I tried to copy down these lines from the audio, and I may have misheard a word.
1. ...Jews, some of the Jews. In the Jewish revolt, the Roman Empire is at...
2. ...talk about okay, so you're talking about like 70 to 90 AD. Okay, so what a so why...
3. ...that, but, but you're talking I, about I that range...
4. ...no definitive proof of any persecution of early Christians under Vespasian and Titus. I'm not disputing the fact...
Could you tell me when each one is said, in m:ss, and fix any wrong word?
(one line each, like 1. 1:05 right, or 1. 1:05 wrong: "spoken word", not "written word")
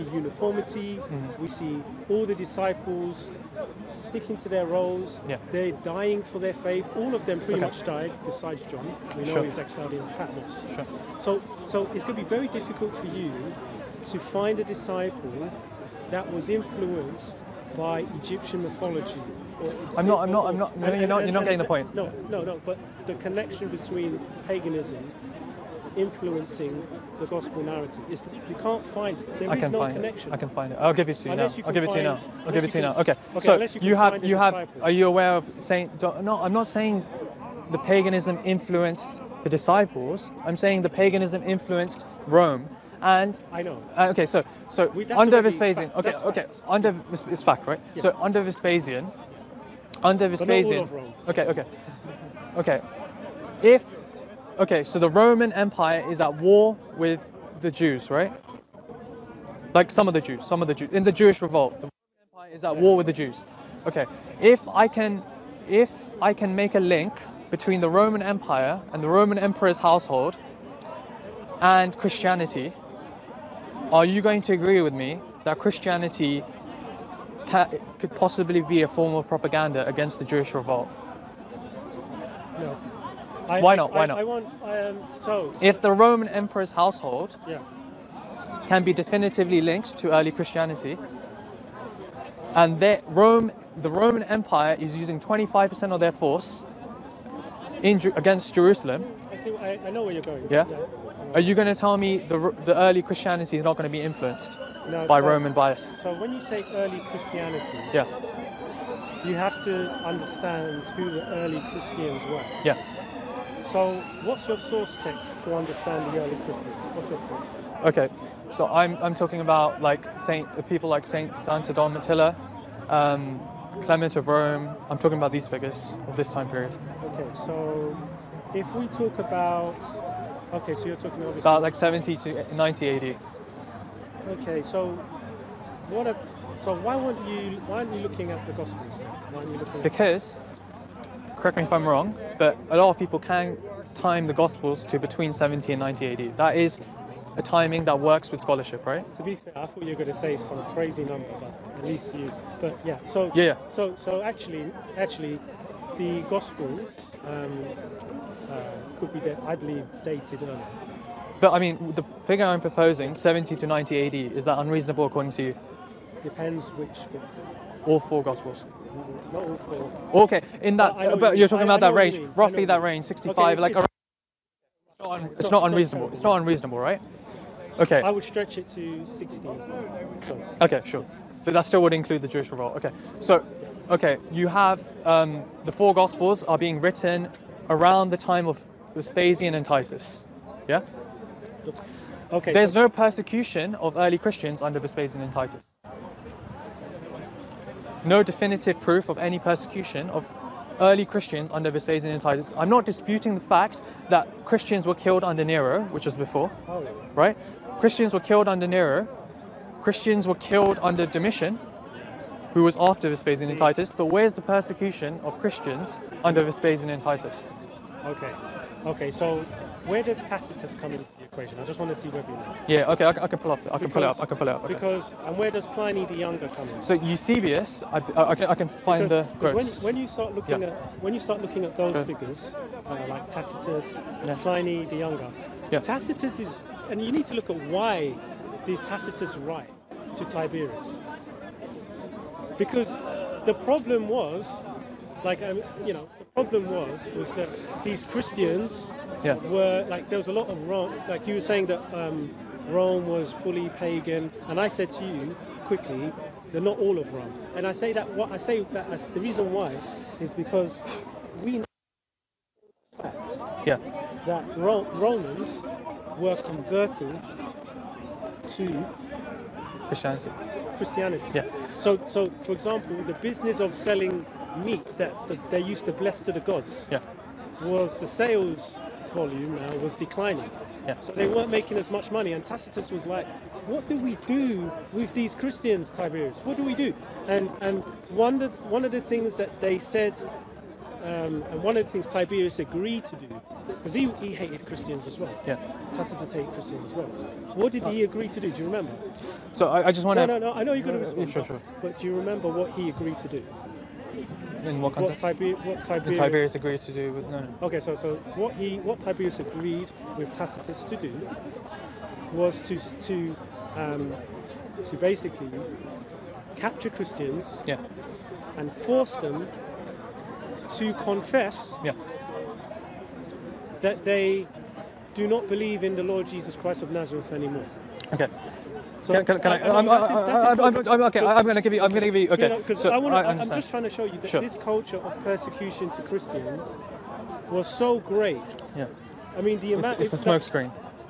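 1. 1:00 right
2. 2:08 right
3. 2:50 right
4. 3:18 right.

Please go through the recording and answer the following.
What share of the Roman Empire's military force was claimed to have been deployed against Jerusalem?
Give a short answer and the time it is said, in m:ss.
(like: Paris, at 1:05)
25%, at 1:35.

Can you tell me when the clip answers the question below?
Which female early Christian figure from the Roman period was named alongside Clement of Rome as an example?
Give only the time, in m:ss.
2:01.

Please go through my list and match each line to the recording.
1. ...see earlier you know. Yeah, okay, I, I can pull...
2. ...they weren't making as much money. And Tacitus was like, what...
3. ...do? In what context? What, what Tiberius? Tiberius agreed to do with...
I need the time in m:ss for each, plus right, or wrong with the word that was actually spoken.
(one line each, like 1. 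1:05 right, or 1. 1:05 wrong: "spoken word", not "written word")
1. 3:41 wrong: "whether", not "earlier"
2. 4:41 right
3. 5:03 right.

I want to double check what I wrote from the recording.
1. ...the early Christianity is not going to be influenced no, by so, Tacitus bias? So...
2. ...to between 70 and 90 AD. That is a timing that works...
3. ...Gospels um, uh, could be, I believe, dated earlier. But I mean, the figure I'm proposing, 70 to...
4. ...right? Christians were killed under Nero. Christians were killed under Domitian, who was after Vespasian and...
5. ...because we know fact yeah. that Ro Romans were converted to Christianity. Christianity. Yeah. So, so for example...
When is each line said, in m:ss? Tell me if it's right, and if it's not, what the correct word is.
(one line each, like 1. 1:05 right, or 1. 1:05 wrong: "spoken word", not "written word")
1. 1:42 wrong: "Roman", not "Tacitus"
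2. 2:24 right
3. 2:36 right
4. 3:27 right
5. 4:20 right.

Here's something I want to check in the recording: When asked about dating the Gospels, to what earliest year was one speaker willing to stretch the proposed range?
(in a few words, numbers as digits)
60.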